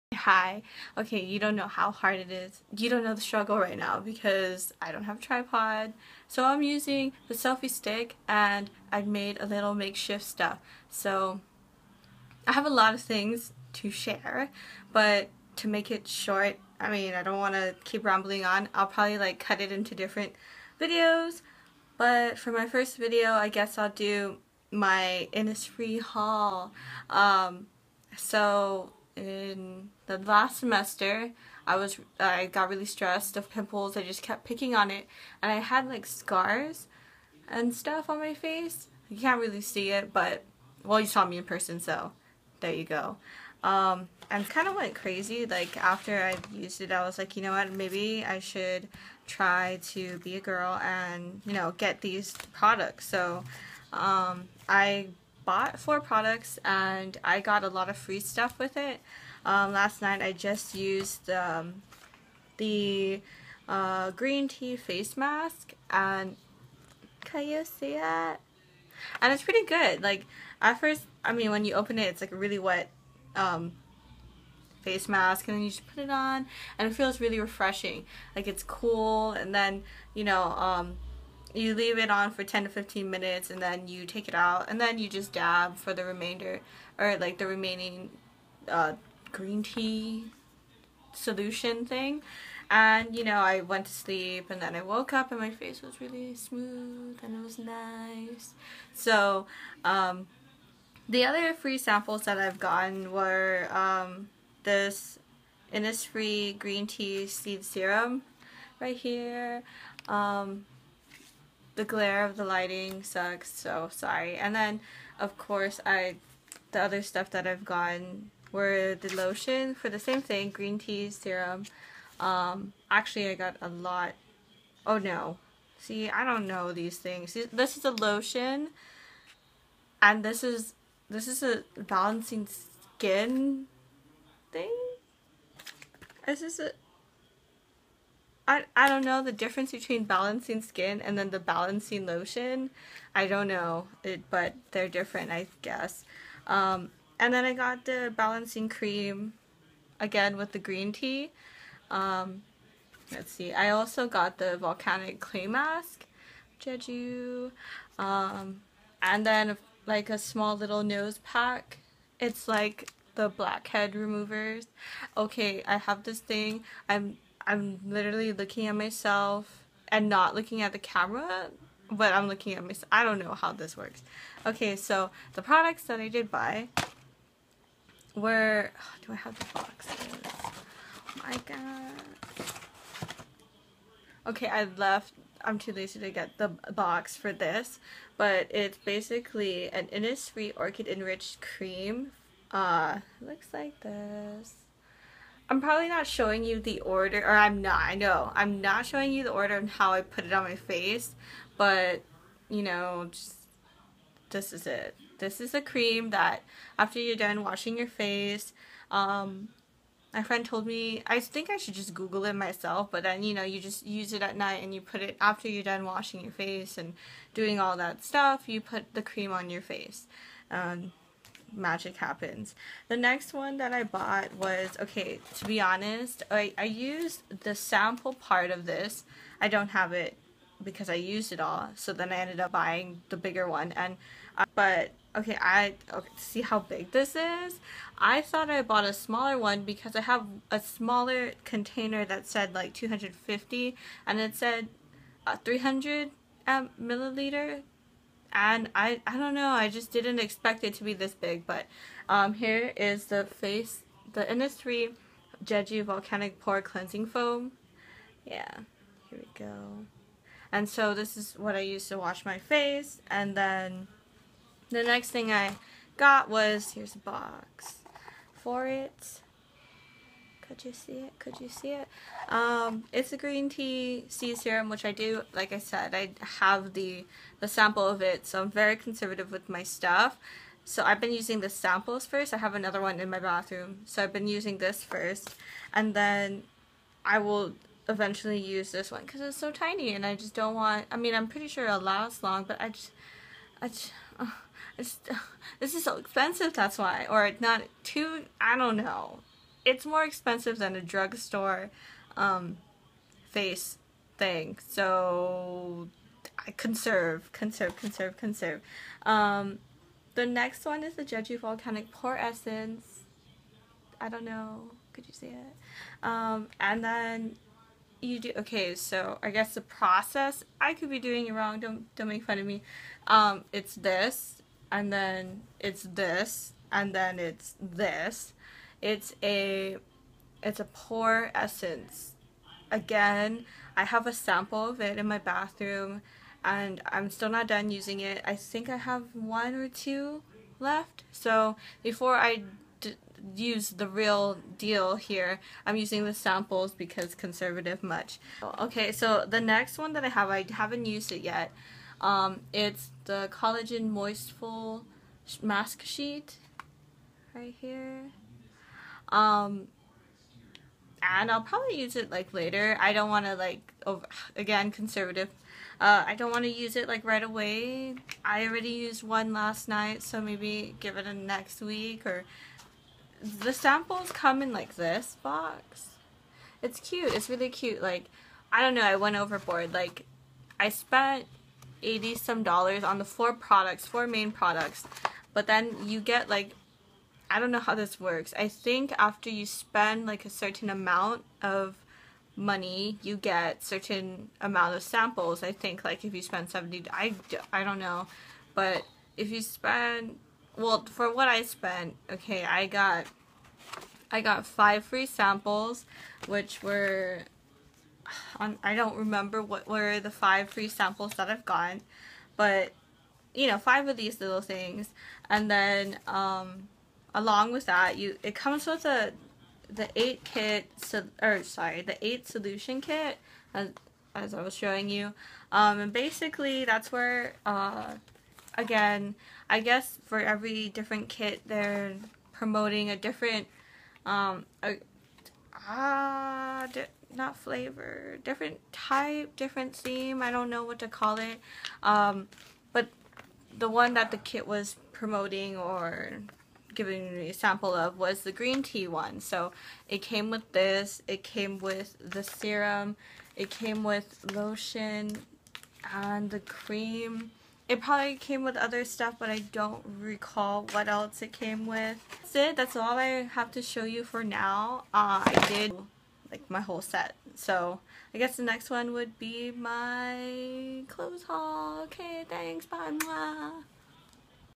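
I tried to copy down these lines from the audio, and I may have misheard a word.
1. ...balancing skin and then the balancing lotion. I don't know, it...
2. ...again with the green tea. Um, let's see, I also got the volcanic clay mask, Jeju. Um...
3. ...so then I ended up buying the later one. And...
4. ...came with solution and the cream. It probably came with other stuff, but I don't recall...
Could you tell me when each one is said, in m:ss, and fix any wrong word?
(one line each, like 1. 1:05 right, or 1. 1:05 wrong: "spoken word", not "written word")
1. 2:20 right
2. 2:29 right
3. 3:51 wrong: "bigger", not "later"
4. 7:33 wrong: "lotion", not "solution".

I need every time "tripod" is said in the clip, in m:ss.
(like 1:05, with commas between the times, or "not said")
0:05.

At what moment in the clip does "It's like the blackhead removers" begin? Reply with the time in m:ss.
2:42.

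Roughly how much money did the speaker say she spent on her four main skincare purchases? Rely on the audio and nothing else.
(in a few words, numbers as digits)
80 some dollars.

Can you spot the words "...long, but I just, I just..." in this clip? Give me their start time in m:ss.
4:52.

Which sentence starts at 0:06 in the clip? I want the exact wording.
So I'm using the selfie stick and I've made a little makeshift stuff.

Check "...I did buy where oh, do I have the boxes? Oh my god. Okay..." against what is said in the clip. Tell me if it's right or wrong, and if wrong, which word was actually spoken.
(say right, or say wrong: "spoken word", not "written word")
right.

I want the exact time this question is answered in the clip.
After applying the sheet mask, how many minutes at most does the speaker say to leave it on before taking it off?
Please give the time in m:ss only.
1:22.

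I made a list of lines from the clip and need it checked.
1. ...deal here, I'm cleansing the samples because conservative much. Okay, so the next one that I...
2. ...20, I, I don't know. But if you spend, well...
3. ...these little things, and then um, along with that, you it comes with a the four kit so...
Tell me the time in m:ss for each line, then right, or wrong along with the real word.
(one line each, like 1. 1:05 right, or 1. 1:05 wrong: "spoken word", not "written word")
1. 5:44 wrong: "using", not "cleansing"
2. 6:36 wrong: "70", not "20"
3. 6:53 wrong: "eight", not "four".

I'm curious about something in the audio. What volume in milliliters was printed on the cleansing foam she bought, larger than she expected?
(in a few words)
300.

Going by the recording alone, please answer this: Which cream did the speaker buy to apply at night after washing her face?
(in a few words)
Innisfree Orchid Enriched Cream.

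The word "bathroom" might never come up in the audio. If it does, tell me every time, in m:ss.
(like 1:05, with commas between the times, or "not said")
4:43, 5:35.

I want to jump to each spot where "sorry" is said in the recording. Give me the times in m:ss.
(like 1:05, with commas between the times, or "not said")
1:53, 7:01.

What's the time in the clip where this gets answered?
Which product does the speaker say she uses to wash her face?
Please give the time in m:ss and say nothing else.
4:15.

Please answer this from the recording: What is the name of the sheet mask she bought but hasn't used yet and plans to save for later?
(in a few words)
Collagen Moistful Mask Sheet.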